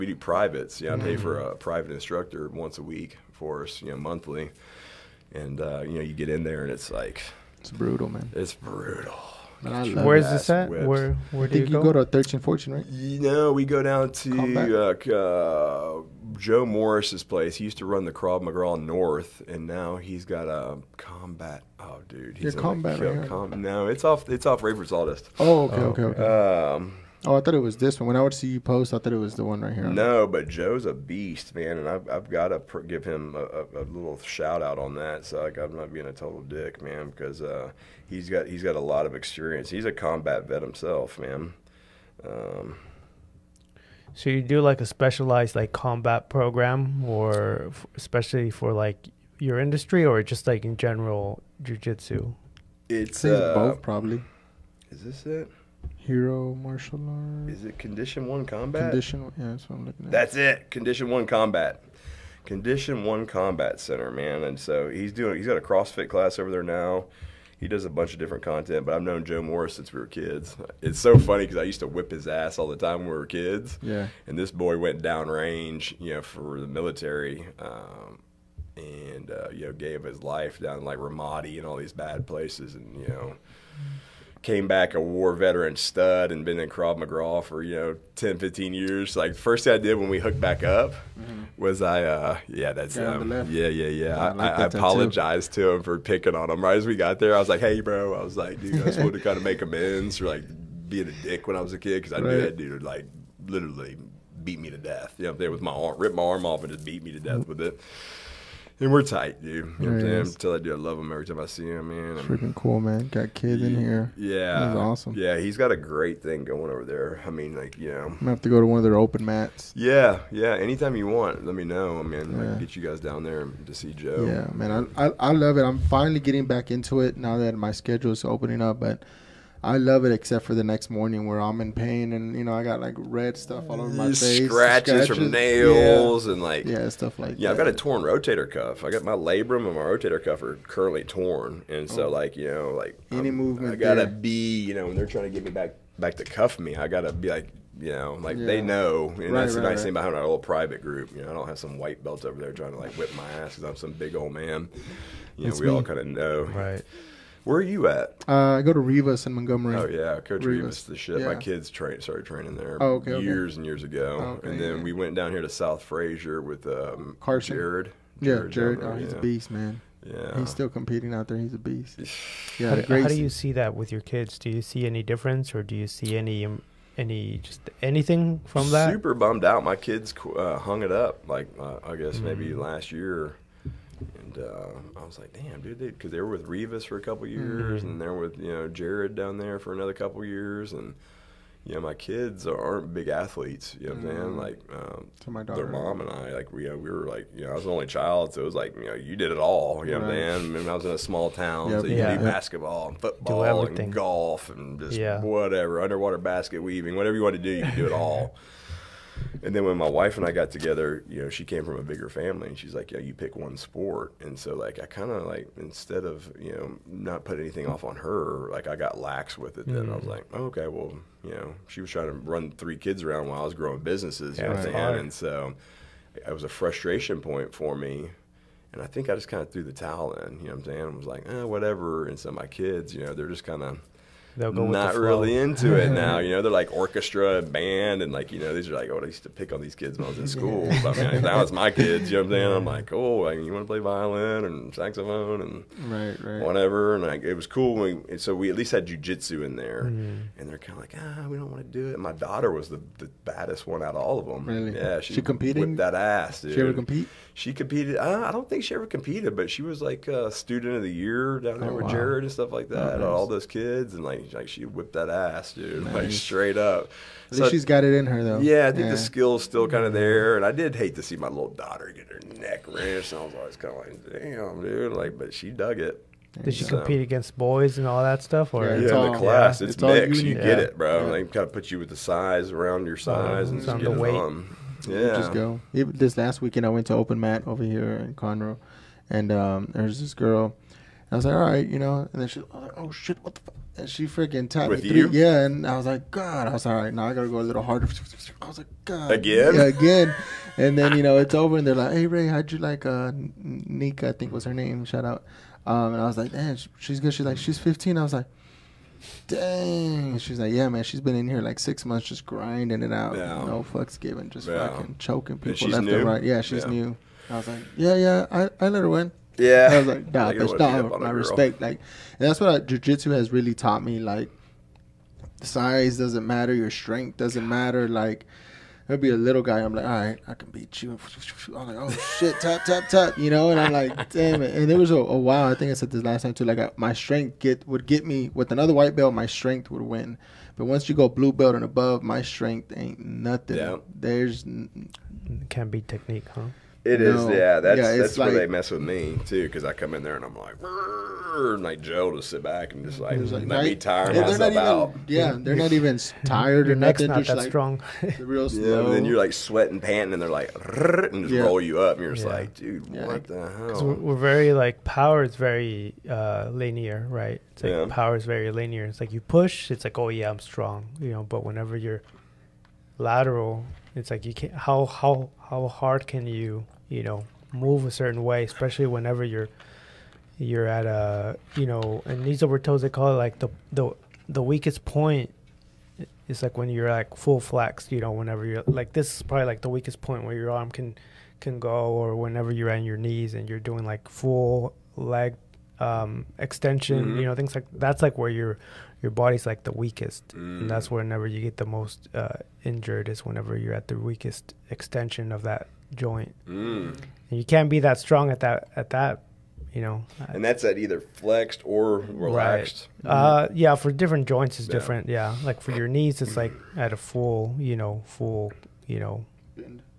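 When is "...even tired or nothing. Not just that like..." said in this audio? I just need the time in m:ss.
5:55.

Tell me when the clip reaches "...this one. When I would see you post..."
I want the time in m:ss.
0:27.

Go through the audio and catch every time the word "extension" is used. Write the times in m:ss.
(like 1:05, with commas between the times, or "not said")
6:36, 6:44.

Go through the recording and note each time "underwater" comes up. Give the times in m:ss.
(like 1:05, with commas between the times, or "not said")
3:25.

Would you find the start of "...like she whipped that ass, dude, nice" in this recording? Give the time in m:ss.
4:24.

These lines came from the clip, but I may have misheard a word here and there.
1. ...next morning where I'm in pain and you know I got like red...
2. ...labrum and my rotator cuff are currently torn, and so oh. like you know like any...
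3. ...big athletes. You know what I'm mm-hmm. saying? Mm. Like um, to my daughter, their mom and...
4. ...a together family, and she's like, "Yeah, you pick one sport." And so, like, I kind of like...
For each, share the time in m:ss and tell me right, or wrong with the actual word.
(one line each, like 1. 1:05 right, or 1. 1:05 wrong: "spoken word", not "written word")
1. 2:10 right
2. 2:19 right
3. 3:12 right
4. 3:31 wrong: "bigger", not "together".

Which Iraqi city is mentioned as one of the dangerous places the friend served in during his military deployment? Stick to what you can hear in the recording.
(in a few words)
Ramadi.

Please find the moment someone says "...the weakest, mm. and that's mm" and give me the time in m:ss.
6:39.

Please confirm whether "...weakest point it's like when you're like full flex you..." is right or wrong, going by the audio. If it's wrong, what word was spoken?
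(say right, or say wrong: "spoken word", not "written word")
right.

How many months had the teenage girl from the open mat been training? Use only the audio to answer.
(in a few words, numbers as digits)
6.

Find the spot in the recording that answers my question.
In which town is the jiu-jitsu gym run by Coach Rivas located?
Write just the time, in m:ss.
2:39.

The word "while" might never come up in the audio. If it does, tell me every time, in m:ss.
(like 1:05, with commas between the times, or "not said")
3:43, 5:35.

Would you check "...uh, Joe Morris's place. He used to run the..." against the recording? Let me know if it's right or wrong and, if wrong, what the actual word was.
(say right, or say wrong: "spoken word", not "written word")
right.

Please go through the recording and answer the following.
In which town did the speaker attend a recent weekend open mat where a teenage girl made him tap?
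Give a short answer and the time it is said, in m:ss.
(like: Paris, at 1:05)
Conroe, at 4:48.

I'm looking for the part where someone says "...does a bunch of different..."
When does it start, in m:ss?
1:07.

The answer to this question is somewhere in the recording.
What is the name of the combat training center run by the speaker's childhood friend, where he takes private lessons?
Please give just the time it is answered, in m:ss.
1:02.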